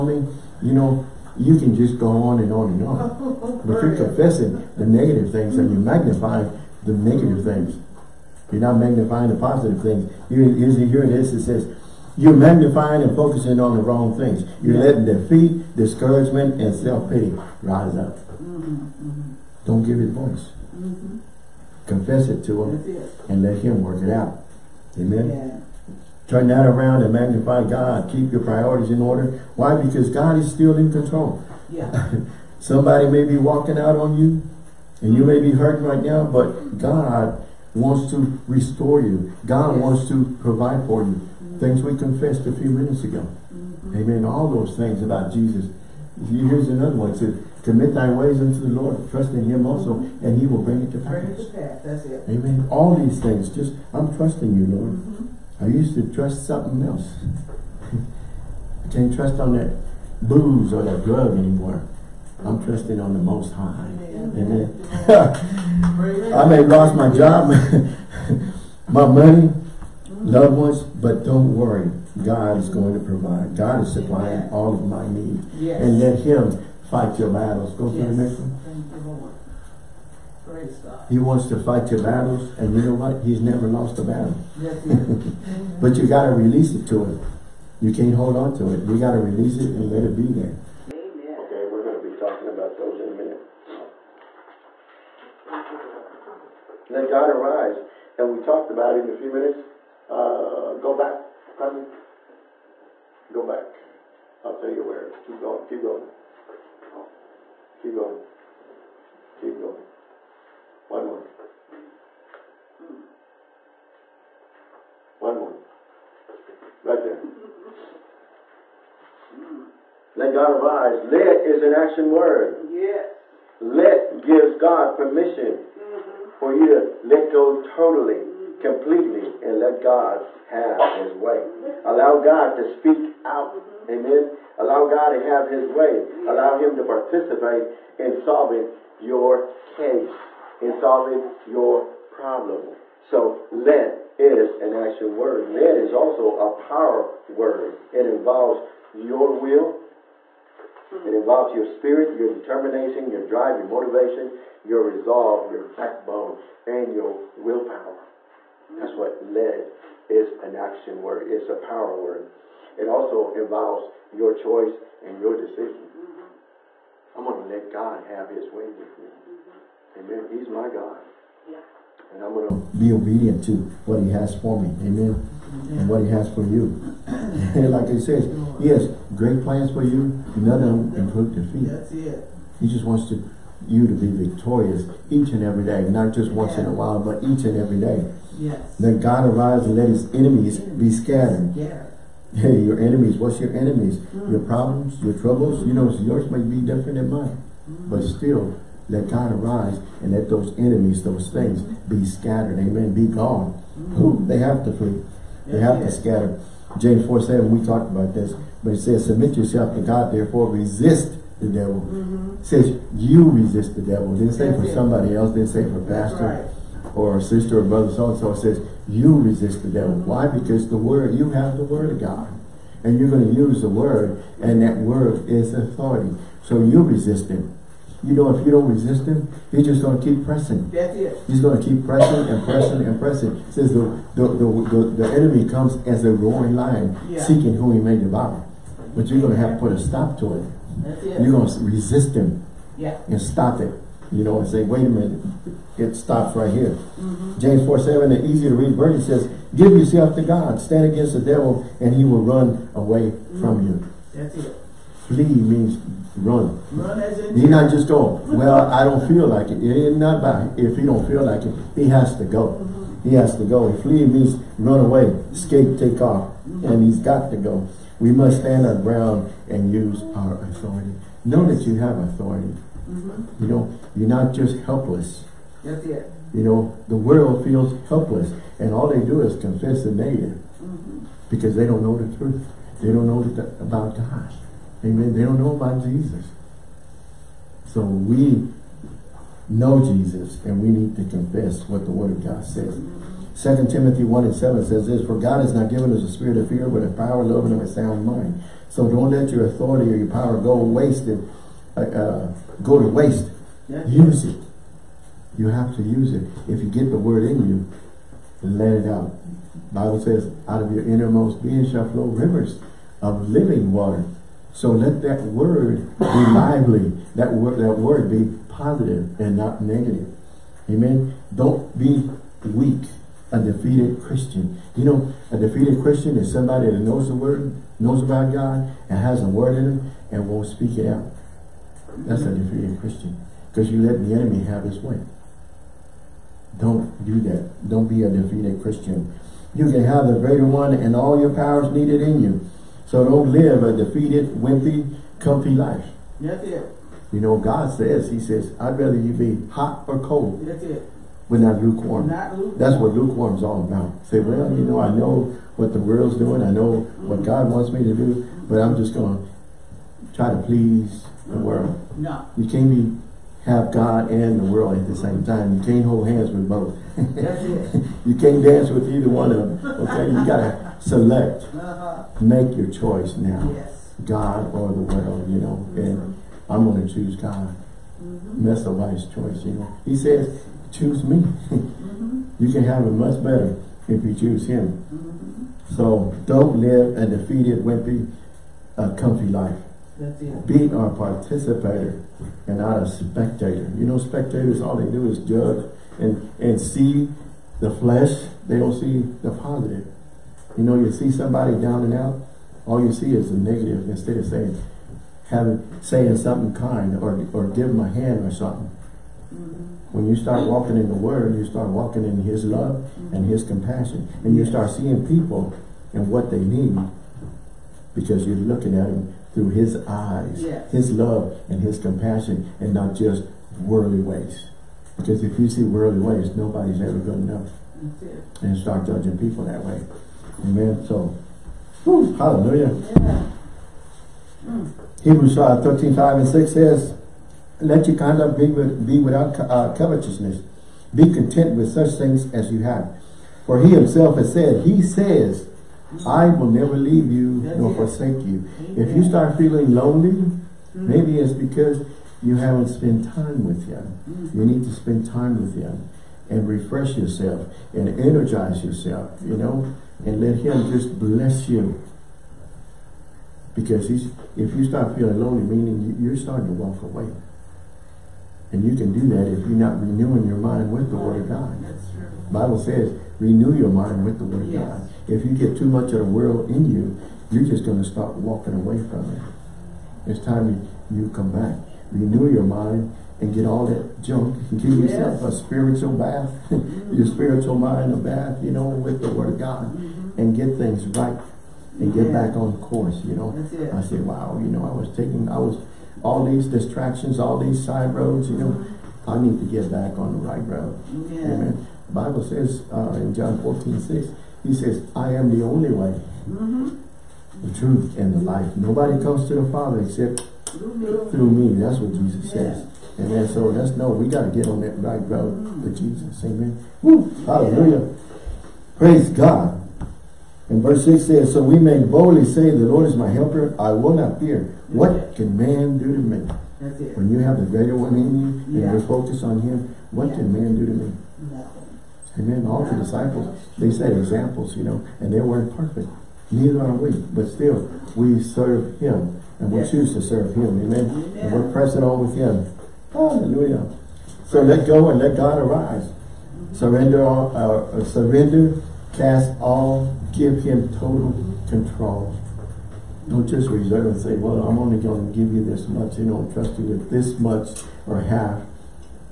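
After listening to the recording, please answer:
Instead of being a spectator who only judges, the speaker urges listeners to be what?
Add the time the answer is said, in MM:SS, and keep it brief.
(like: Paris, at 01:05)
a participator, at 06:30.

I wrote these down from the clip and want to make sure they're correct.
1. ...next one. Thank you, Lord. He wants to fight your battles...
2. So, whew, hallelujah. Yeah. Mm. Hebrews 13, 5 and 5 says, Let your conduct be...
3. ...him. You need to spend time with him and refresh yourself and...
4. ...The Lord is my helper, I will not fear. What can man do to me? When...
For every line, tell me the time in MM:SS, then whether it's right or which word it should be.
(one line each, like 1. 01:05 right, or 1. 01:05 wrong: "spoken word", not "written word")
1. 01:18 right
2. 07:10 wrong: "6", not "5"
3. 07:33 right
4. 08:42 right.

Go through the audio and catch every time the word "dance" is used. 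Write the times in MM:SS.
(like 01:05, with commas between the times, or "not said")
06:08.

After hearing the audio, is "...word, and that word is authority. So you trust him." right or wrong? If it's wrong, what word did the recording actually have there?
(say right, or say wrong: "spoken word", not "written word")
wrong: "resist", not "trust".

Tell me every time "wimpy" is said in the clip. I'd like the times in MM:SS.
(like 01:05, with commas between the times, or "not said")
05:44, 06:27.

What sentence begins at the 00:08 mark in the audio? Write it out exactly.
You're not magnifying the positive things.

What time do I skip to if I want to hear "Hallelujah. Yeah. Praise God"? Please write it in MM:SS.
08:37.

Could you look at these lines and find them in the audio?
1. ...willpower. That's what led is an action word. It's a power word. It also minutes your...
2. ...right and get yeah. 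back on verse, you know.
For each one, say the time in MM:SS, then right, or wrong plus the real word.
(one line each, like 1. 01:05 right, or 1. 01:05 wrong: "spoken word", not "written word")
1. 02:37 wrong: "involves", not "minutes"
2. 08:10 wrong: "course", not "verse".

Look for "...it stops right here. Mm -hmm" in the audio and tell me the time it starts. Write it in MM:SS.
04:05.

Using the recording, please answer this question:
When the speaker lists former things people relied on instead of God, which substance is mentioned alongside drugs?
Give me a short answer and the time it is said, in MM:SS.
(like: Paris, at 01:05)
booze, at 01:00.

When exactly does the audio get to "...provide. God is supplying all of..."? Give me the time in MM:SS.
01:13.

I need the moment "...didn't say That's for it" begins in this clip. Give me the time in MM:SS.
03:34.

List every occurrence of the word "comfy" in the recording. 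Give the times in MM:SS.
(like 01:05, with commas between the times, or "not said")
05:45, 06:28.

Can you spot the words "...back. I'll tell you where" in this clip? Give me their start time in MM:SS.
01:43.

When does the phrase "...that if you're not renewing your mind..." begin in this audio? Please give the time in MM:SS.
07:49.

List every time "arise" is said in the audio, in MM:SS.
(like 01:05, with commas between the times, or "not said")
01:37, 02:00, 03:09, 03:19, 09:05.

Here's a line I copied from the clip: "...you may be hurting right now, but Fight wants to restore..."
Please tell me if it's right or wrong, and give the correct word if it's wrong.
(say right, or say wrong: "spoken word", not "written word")
wrong: "God", not "Fight".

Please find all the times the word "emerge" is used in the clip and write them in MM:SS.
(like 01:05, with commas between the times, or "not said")
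not said.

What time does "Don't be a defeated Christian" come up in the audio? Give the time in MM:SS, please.
05:37.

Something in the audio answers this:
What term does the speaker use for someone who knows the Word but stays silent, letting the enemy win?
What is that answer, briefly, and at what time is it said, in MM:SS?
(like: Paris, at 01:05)
inferior Christian, at 05:32.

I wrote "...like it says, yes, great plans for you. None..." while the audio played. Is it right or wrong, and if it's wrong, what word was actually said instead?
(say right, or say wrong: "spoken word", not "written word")
right.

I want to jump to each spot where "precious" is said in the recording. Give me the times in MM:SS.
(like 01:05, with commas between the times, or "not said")
not said.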